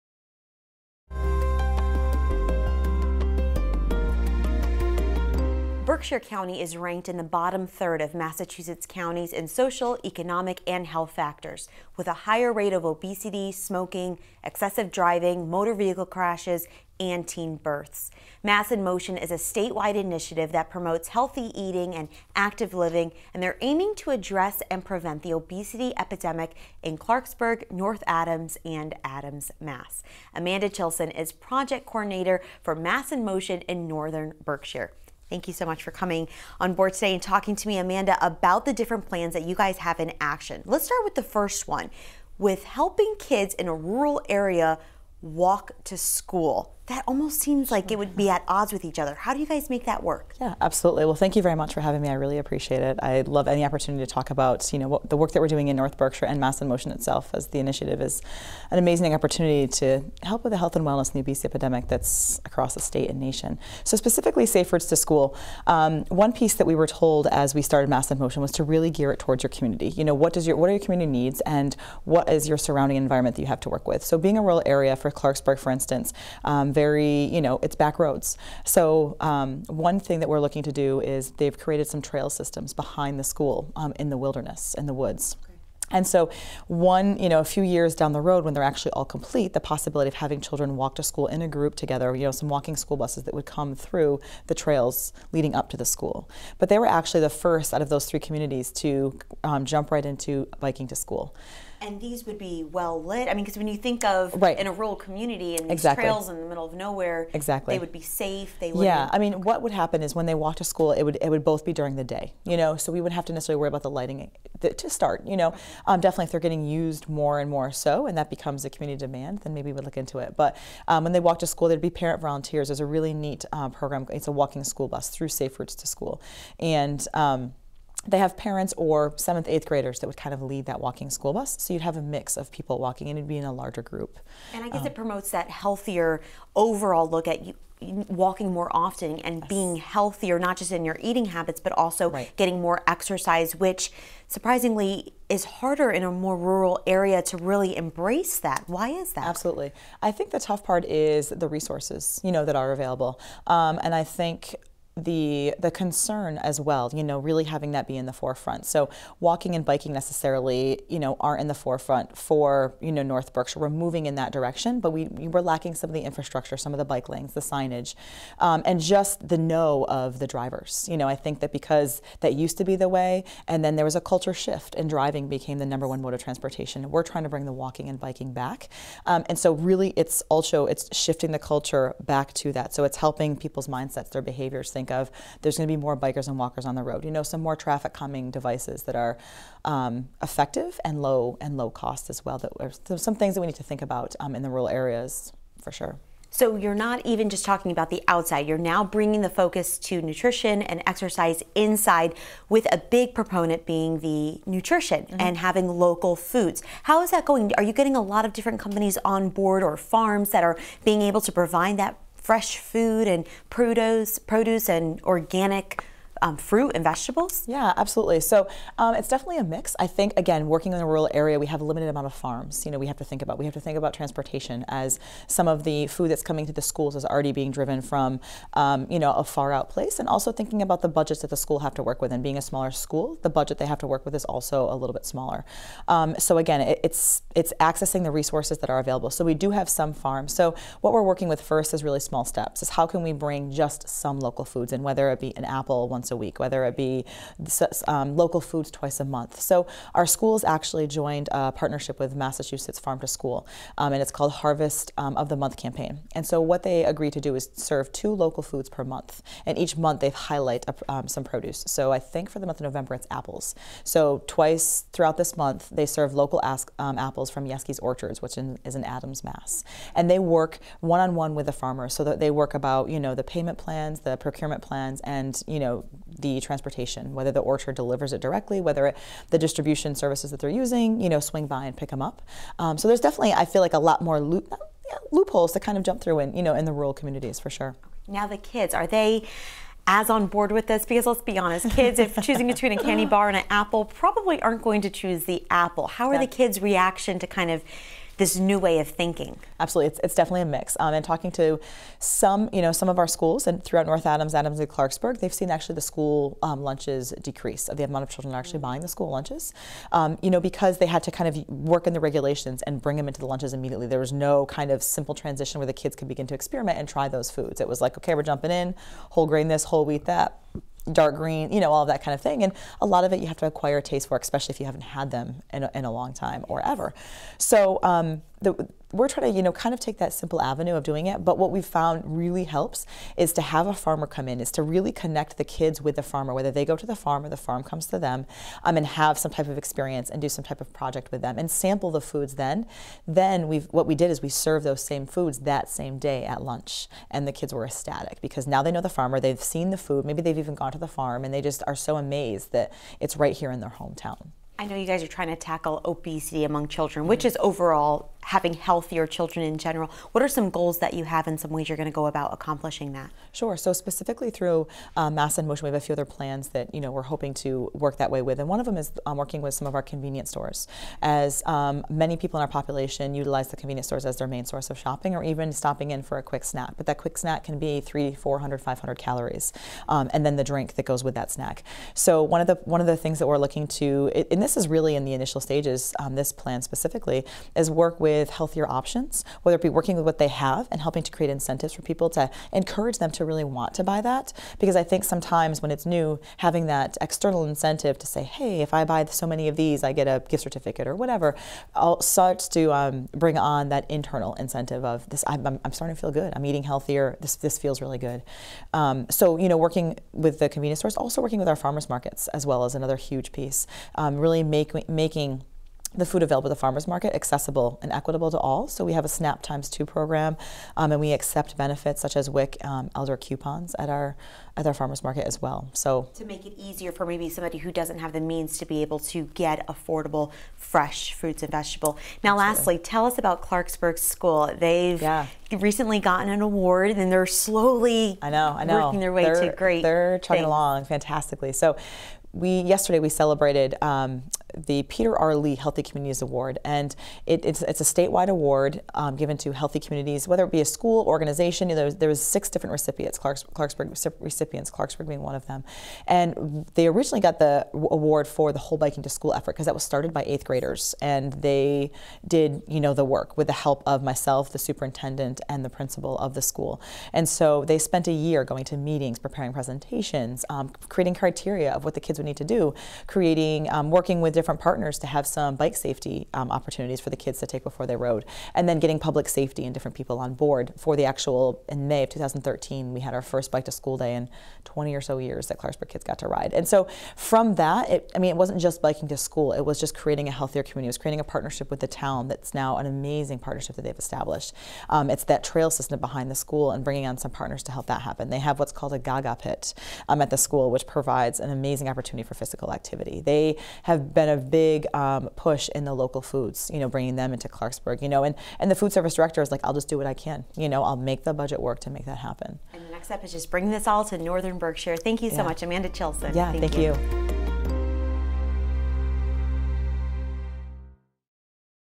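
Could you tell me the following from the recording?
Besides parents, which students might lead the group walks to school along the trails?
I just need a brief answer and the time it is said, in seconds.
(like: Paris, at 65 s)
seventh, eighth graders, at 129 s.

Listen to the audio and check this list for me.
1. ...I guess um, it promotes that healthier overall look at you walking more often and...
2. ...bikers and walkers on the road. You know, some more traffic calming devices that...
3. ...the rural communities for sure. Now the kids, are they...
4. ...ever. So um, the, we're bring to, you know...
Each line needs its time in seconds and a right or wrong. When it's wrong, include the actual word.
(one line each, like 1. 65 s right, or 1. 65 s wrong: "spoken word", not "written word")
1. 134 s right
2. 185 s right
3. 286 s right
4. 326 s wrong: "trying", not "bring".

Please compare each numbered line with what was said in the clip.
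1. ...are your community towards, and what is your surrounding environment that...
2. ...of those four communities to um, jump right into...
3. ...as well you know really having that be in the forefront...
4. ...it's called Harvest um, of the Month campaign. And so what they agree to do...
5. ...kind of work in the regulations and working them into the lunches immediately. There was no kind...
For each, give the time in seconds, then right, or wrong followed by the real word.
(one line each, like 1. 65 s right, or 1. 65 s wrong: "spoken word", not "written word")
1. 70 s wrong: "needs", not "towards"
2. 97 s wrong: "three", not "four"
3. 156 s right
4. 254 s right
5. 311 s wrong: "bring", not "working".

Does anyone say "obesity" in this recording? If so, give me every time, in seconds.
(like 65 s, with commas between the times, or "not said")
12 s, 25 s, 61 s, 355 s.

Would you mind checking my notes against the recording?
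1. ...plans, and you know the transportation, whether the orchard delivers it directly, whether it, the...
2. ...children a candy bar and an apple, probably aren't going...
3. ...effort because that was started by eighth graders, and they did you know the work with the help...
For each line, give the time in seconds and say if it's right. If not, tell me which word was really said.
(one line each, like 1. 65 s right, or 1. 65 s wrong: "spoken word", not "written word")
1. 274 s right
2. 292 s wrong: "between", not "children"
3. 459 s right.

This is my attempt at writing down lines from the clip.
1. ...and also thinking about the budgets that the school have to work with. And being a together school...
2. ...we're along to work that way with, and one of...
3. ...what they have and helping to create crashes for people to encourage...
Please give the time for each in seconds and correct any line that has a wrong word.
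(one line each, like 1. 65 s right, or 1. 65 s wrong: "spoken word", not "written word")
1. 229 s wrong: "smaller", not "together"
2. 366 s wrong: "hoping", not "along"
3. 390 s wrong: "incentives", not "crashes".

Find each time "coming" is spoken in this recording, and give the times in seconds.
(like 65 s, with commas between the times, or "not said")
35 s, 226 s.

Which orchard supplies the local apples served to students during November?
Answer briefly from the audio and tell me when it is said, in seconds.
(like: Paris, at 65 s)
Jaeschke's Orchards, at 267 s.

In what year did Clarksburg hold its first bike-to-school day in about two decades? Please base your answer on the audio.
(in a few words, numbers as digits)
2013.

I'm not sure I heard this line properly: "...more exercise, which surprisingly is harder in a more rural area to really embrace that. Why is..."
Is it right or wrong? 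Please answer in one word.
right.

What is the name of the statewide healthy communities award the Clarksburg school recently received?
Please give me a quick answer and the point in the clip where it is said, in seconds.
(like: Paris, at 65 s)
Peter R. Lee Healthy Communities Award, at 444 s.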